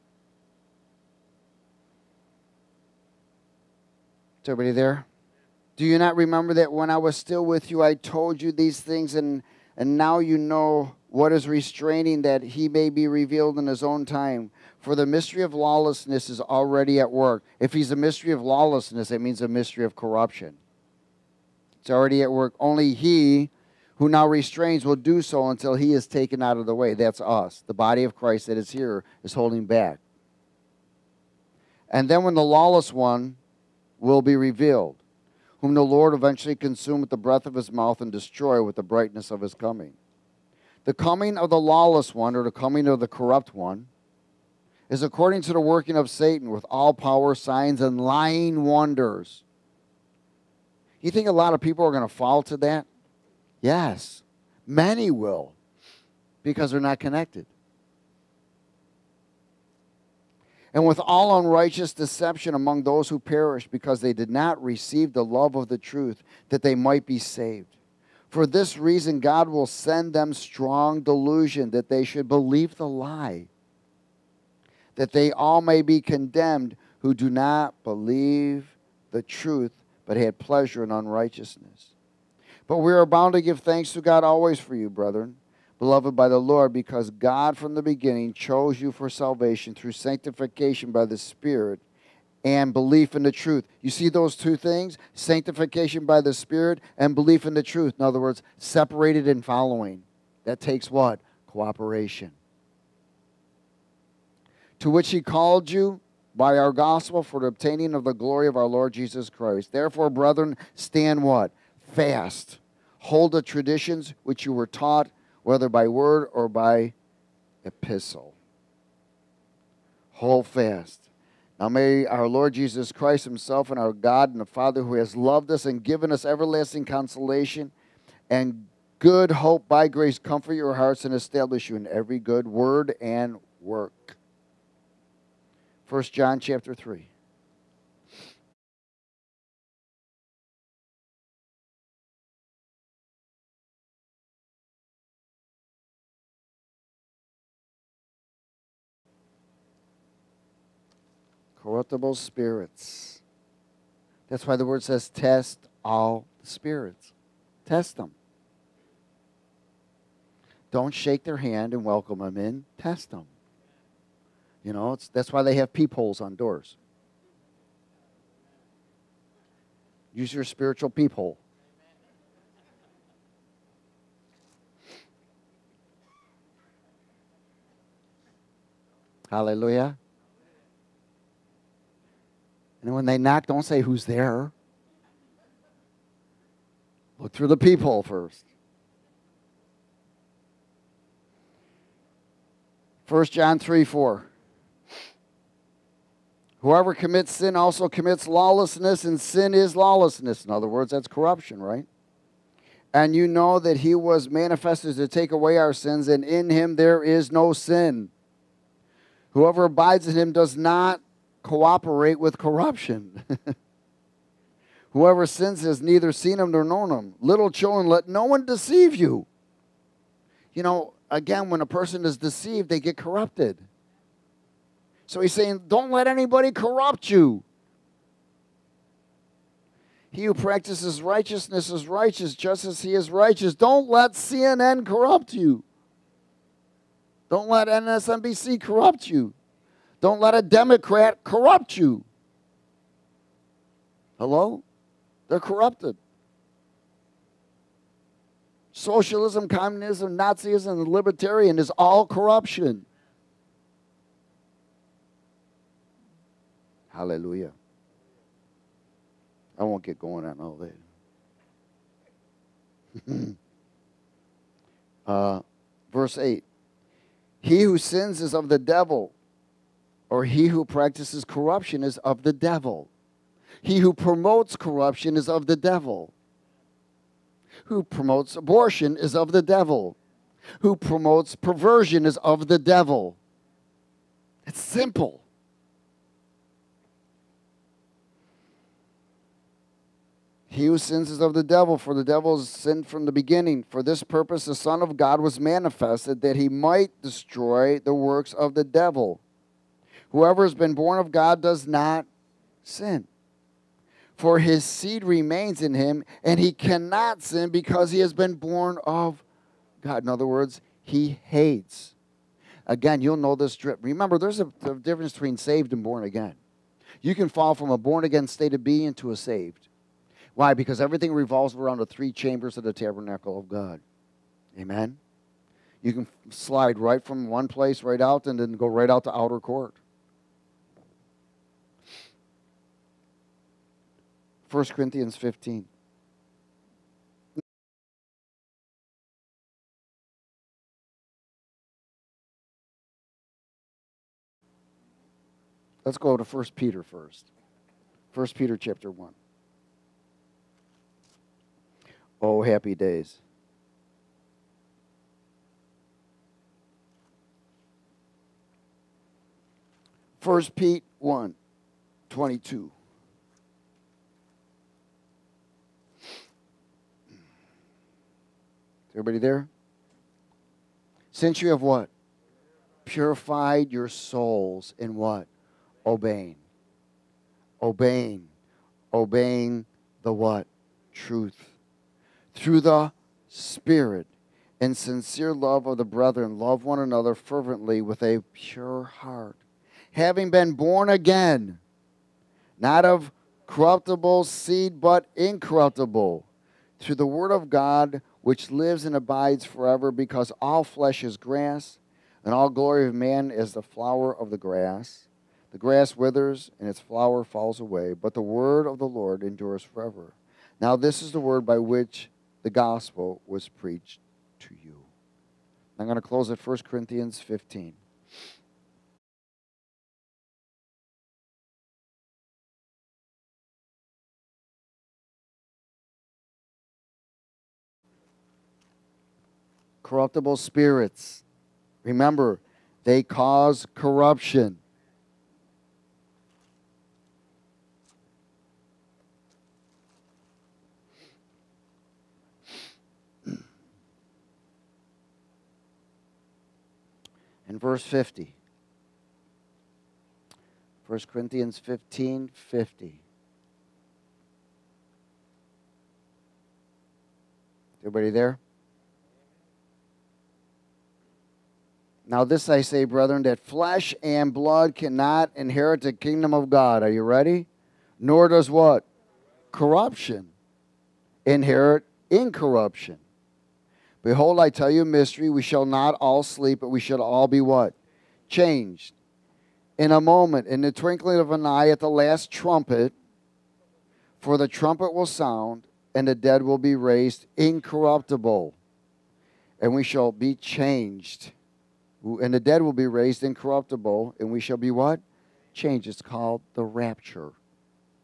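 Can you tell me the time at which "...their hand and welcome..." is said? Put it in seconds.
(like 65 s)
161 s.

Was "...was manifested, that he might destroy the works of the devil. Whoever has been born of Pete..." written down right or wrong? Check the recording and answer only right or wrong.
wrong.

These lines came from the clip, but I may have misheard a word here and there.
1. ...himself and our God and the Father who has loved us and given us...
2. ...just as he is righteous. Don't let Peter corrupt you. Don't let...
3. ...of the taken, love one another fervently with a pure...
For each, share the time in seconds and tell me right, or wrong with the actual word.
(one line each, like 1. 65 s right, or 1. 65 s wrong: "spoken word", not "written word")
1. 123 s right
2. 232 s wrong: "CNN", not "Peter"
3. 385 s wrong: "brethren", not "taken".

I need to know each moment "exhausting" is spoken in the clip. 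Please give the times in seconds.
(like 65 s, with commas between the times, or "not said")
not said.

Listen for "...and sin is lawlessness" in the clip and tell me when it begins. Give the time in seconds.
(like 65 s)
199 s.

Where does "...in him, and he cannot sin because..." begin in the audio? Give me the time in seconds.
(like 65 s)
305 s.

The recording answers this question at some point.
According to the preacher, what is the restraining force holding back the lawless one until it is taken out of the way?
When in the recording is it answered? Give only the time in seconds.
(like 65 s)
27 s.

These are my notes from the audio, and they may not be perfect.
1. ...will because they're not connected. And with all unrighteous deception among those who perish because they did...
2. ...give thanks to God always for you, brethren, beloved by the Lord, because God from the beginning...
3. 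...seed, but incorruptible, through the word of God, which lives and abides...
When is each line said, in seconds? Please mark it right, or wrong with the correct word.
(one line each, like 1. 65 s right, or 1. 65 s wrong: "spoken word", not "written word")
1. 55 s right
2. 83 s right
3. 394 s right.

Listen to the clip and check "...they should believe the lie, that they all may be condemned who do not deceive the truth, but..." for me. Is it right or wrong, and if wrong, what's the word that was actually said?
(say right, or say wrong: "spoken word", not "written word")
wrong: "believe", not "deceive".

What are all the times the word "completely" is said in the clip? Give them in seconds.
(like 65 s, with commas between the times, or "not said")
not said.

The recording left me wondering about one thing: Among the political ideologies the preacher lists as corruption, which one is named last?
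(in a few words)
Libertarian.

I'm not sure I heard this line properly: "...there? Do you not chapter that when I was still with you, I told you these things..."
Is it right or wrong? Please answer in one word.
wrong.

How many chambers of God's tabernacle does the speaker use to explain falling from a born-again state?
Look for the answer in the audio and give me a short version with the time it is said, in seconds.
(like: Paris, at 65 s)
3, at 321 s.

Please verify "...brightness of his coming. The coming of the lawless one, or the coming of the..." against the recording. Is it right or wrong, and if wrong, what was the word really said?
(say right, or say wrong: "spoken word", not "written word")
right.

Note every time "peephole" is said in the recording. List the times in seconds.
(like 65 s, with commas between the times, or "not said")
165 s, 170 s, 187 s.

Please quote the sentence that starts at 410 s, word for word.
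Now, this is the word by which the gospel was preached to you.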